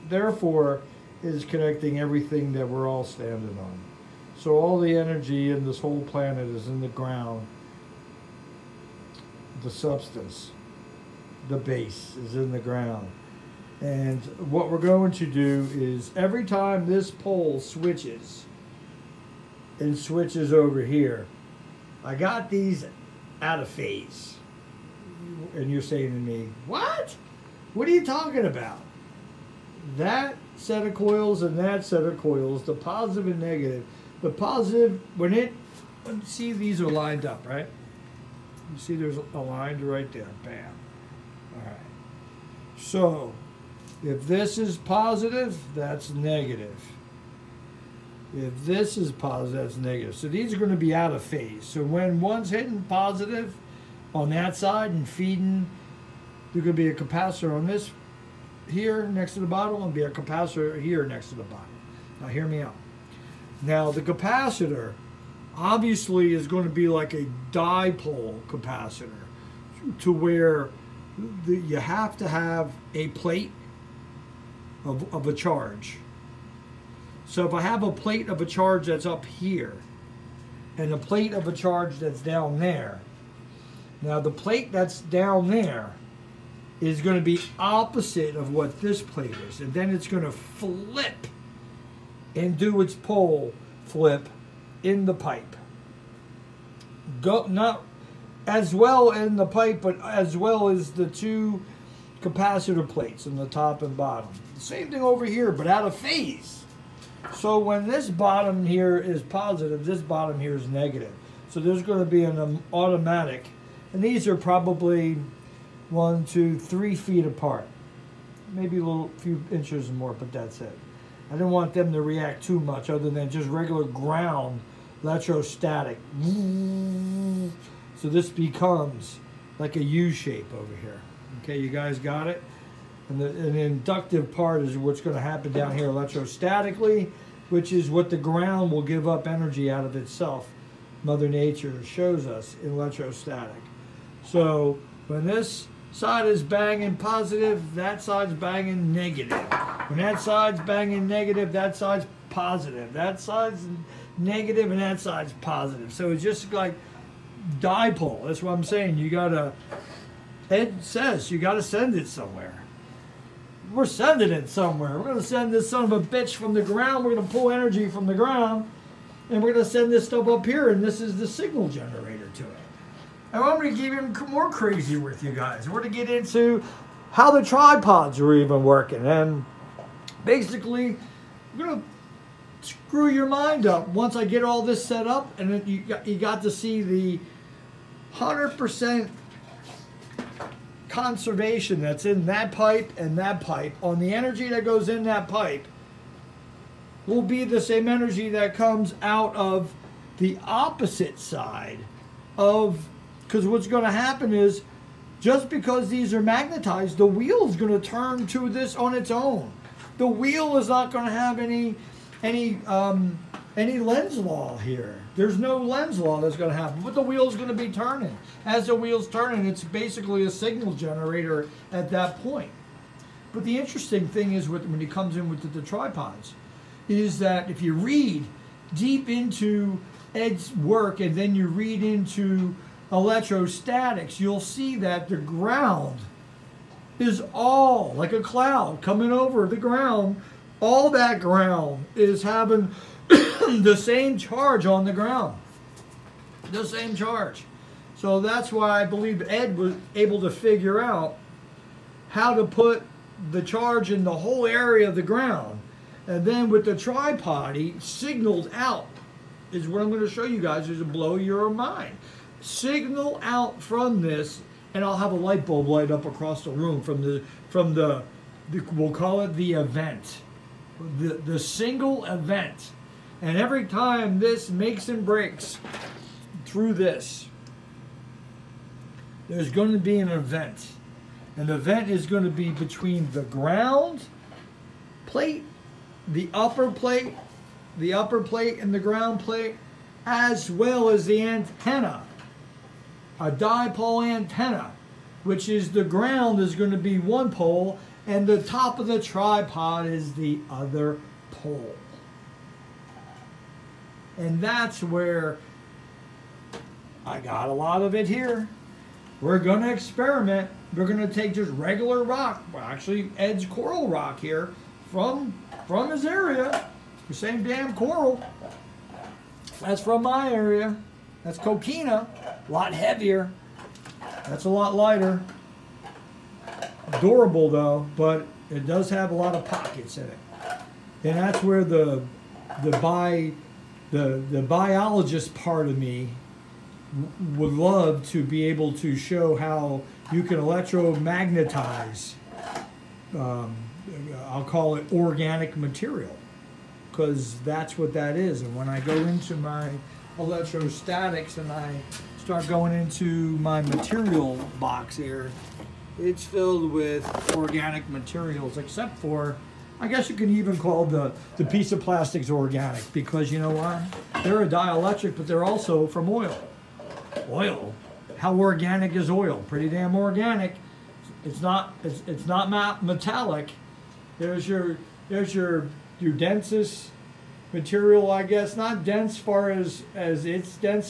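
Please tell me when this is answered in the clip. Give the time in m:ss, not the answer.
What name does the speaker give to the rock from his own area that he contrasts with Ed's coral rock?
5:21.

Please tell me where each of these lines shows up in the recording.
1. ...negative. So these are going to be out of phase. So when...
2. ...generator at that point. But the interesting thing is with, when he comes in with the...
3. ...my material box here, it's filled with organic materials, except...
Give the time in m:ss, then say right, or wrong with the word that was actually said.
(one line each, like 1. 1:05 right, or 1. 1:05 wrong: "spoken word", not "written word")
1. 0:49 right
2. 3:40 right
3. 5:53 right.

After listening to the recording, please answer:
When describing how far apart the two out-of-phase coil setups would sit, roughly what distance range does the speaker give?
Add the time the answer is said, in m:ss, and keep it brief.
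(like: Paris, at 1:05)
1 to 3 feet, at 1:55.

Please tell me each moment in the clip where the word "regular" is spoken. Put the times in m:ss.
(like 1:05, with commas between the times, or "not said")
2:03, 5:11.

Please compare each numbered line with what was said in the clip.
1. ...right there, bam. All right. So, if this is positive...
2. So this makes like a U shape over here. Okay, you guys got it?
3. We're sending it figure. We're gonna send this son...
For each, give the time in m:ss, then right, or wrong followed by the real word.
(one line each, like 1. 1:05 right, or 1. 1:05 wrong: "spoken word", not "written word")
1. 0:39 right
2. 2:08 wrong: "becomes", not "makes"
3. 2:43 wrong: "somewhere", not "figure".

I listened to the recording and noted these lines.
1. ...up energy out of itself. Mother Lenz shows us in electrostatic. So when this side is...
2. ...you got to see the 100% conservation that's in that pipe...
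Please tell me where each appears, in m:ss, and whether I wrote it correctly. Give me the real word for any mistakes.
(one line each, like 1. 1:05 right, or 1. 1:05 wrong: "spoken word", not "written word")
1. 2:19 wrong: "Nature", not "Lenz"
2. 3:06 right.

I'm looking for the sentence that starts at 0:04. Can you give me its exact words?
So all the energy in this whole planet is in the ground.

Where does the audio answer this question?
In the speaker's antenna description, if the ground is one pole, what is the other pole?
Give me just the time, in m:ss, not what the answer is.
4:58.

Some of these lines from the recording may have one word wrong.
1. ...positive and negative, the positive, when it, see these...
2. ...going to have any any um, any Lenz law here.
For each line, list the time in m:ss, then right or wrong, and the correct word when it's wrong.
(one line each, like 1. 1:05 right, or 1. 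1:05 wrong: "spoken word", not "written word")
1. 0:32 right
2. 3:30 right.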